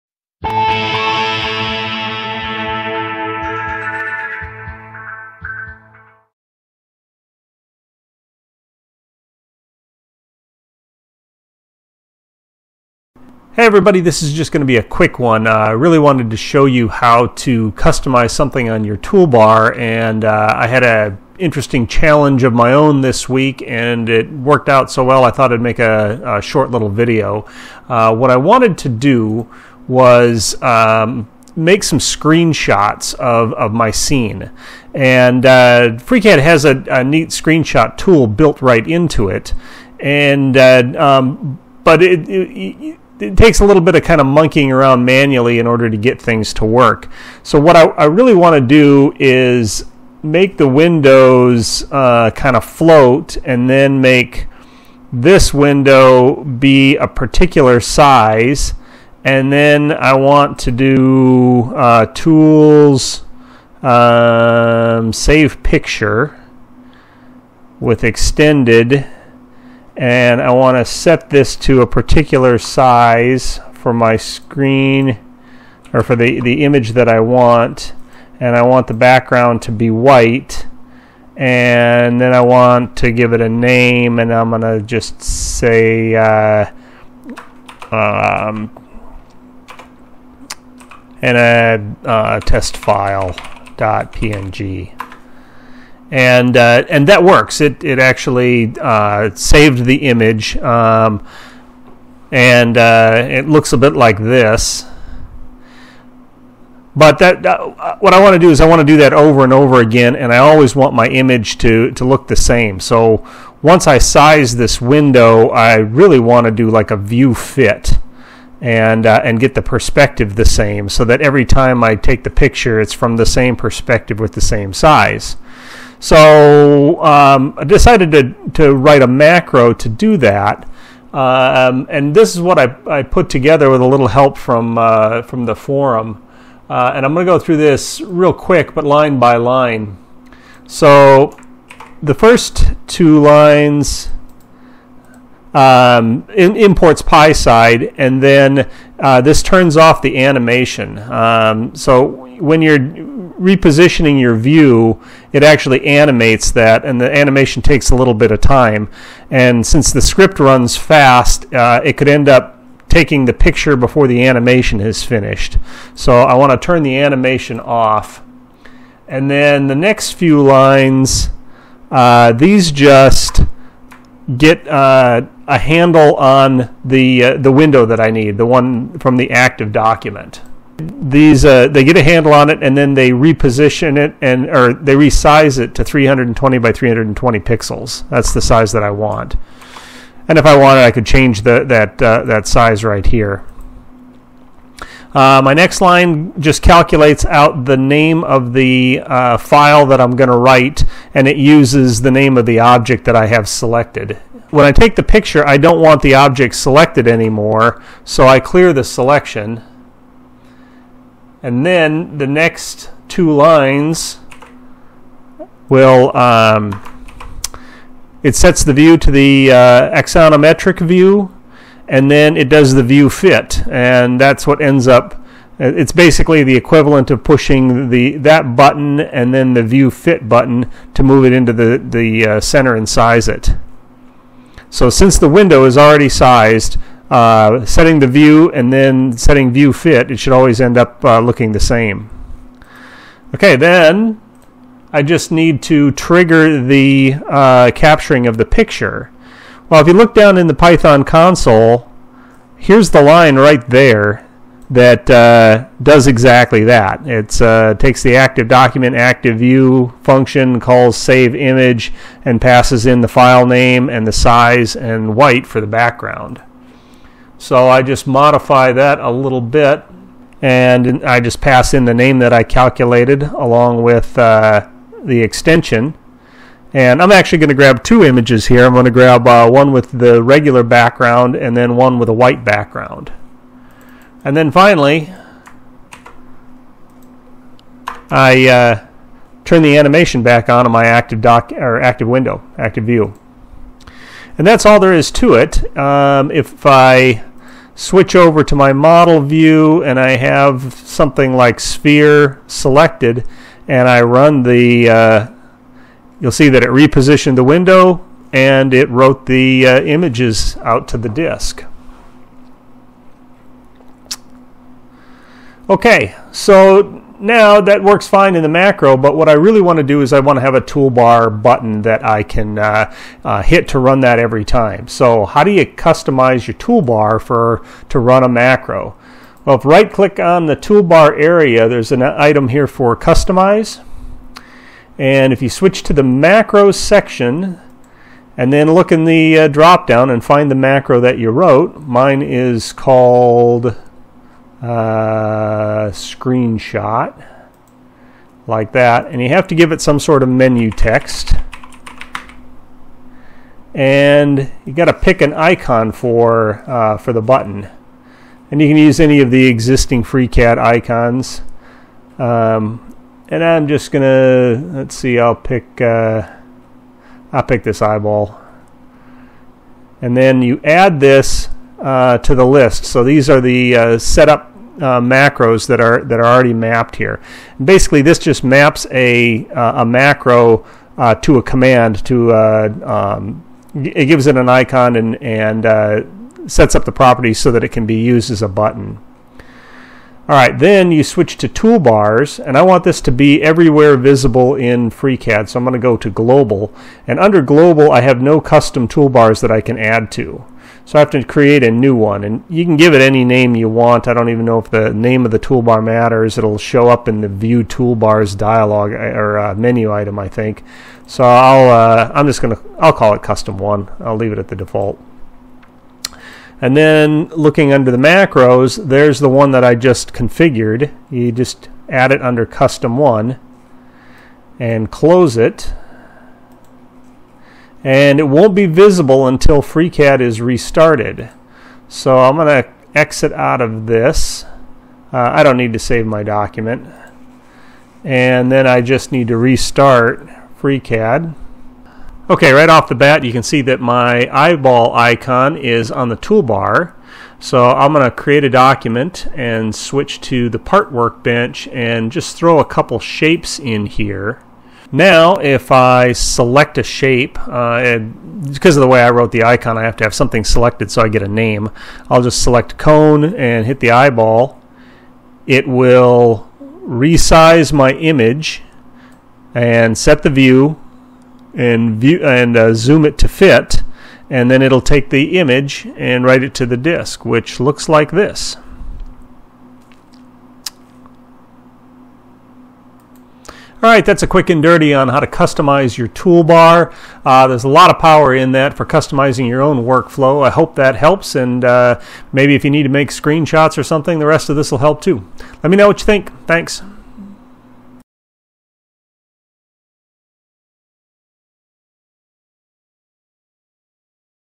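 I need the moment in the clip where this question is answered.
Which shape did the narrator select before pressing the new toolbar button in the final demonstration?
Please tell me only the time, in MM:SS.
07:42.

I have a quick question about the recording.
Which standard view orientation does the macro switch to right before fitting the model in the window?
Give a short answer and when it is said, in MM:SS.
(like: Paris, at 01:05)
Axonometric, at 03:39.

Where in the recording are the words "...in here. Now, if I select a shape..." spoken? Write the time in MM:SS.
07:33.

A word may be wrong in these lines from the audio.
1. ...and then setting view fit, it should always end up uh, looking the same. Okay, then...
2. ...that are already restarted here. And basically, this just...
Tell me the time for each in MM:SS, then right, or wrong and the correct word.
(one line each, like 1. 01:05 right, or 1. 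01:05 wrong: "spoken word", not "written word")
1. 03:58 right
2. 06:16 wrong: "mapped", not "restarted".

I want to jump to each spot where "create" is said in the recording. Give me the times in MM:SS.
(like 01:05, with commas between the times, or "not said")
06:41, 07:28.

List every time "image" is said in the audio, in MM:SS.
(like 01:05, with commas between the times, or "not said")
01:16, 01:40, 01:51, 04:21, 04:38, 05:09, 07:47, 07:55.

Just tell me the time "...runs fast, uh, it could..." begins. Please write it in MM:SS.
02:40.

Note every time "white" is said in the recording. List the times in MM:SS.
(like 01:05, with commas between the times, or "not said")
01:19, 04:25, 04:42.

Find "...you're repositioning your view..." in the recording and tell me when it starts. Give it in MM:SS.
02:32.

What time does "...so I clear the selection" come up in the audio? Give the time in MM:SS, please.
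03:28.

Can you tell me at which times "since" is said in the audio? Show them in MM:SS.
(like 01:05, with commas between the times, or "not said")
02:39, 03:54.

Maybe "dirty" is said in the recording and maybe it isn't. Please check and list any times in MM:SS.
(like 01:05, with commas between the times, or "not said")
08:04.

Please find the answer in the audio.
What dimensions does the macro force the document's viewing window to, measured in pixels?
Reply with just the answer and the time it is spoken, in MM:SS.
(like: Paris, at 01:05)
320 by 320, at 03:05.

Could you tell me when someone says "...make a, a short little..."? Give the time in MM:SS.
00:25.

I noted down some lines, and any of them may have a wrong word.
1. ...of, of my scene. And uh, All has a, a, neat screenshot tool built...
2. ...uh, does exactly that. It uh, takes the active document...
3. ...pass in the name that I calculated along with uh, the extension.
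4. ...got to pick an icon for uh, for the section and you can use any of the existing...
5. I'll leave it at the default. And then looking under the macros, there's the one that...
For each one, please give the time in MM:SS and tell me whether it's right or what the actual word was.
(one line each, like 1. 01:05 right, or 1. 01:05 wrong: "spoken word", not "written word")
1. 00:33 wrong: "FreeCAD", not "All"
2. 04:15 right
3. 04:31 right
4. 05:54 wrong: "button", not "section"
5. 06:53 right.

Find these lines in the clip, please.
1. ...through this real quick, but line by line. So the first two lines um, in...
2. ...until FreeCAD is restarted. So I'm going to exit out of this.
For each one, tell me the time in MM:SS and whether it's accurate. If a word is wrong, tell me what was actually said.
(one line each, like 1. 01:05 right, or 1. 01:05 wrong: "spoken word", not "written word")
1. 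02:17 right
2. 07:09 right.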